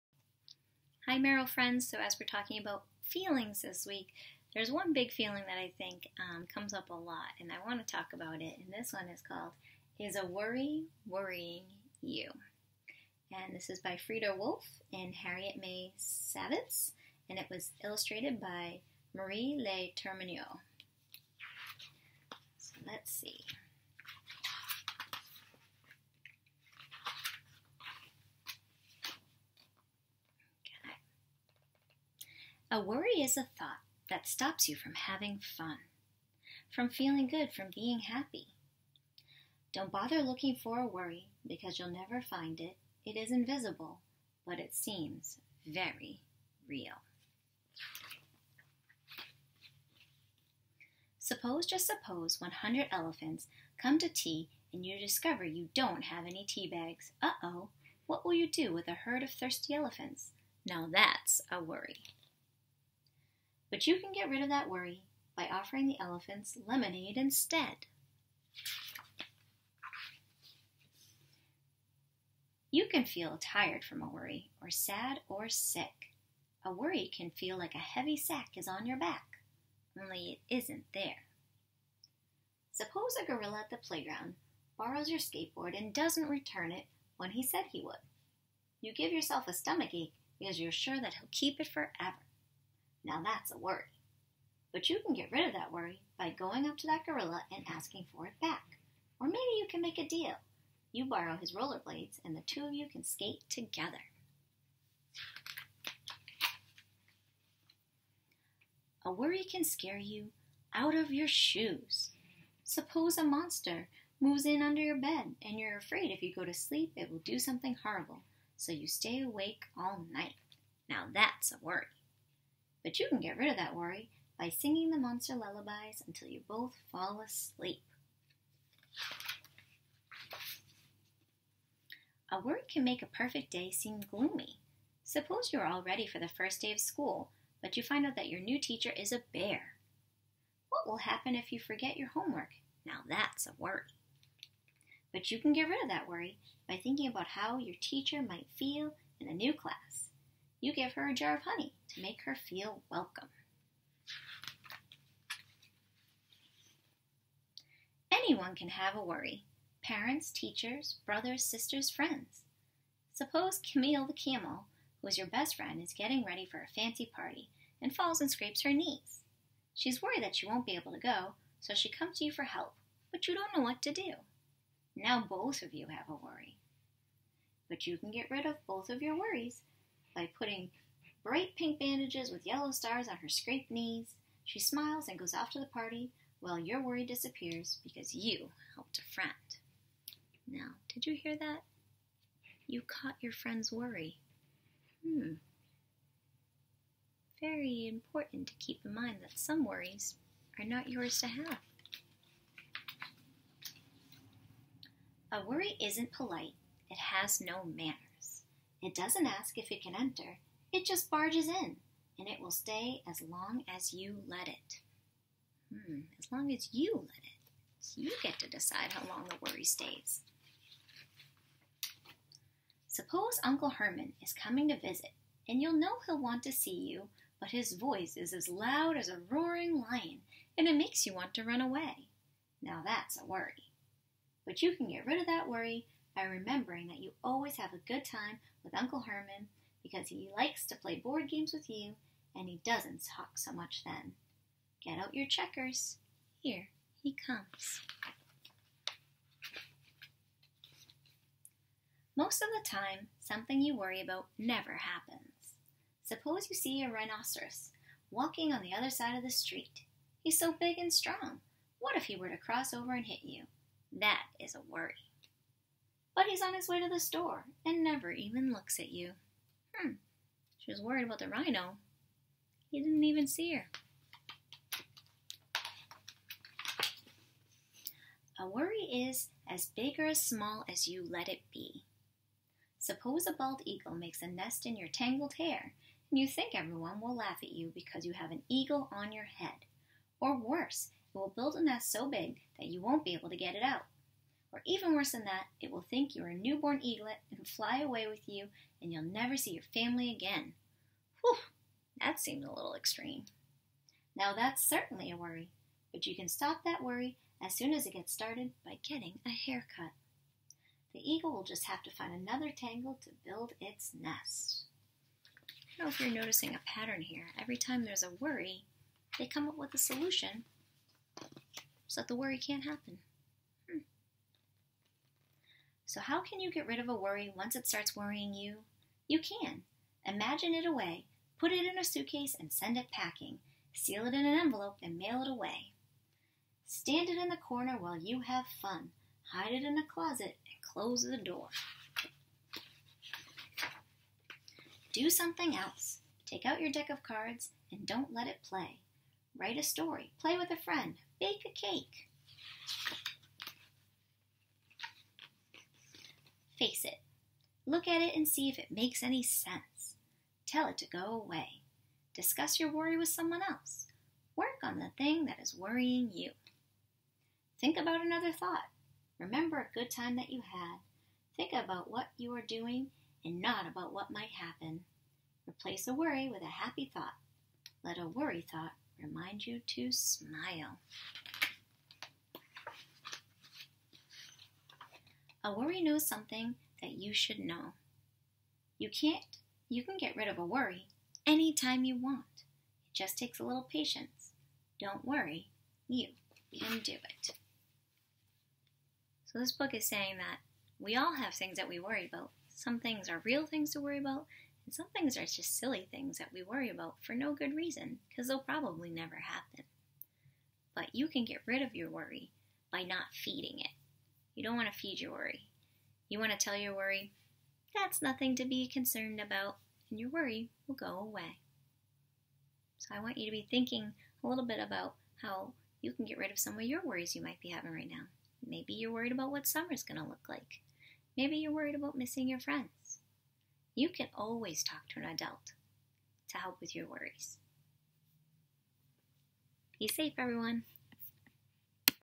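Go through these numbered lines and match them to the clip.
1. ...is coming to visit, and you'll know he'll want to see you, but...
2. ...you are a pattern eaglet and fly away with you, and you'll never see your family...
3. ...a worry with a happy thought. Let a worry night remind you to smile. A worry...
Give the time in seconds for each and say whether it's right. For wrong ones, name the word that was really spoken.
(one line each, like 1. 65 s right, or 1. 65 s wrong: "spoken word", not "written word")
1. 224 s right
2. 296 s wrong: "newborn", not "pattern"
3. 375 s wrong: "thought", not "night".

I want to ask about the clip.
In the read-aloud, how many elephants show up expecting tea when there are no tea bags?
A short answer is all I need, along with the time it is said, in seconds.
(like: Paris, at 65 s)
100, at 52 s.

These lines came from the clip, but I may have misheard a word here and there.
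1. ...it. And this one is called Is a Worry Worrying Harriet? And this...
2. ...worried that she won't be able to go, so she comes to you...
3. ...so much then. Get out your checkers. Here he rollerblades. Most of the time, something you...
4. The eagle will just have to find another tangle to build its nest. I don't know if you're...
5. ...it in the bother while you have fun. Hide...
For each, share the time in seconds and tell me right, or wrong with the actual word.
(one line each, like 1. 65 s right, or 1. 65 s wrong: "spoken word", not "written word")
1. 8 s wrong: "You", not "Harriet"
2. 170 s right
3. 243 s wrong: "comes", not "rollerblades"
4. 310 s right
5. 337 s wrong: "corner", not "bother".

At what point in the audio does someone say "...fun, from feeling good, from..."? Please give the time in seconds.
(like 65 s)
35 s.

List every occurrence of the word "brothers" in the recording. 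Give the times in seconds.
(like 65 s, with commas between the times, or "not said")
161 s.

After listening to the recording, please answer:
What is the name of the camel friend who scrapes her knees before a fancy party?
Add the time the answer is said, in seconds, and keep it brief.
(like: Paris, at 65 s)
Camille, at 163 s.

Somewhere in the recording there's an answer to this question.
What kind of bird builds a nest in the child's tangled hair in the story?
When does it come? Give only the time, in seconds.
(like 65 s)
283 s.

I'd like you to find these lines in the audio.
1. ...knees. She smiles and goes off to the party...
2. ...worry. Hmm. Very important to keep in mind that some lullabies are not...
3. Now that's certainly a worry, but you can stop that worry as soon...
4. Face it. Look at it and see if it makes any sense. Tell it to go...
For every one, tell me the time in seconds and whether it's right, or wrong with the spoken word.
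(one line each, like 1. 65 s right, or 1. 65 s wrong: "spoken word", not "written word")
1. 183 s right
2. 193 s wrong: "worries", not "lullabies"
3. 304 s right
4. 356 s right.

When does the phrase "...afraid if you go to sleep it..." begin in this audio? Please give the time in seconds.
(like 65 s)
115 s.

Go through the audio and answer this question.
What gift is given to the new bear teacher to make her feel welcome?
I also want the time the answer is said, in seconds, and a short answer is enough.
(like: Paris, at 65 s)
A jar of honey, at 151 s.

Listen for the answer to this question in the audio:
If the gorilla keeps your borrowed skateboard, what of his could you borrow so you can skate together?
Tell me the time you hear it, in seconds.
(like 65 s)
101 s.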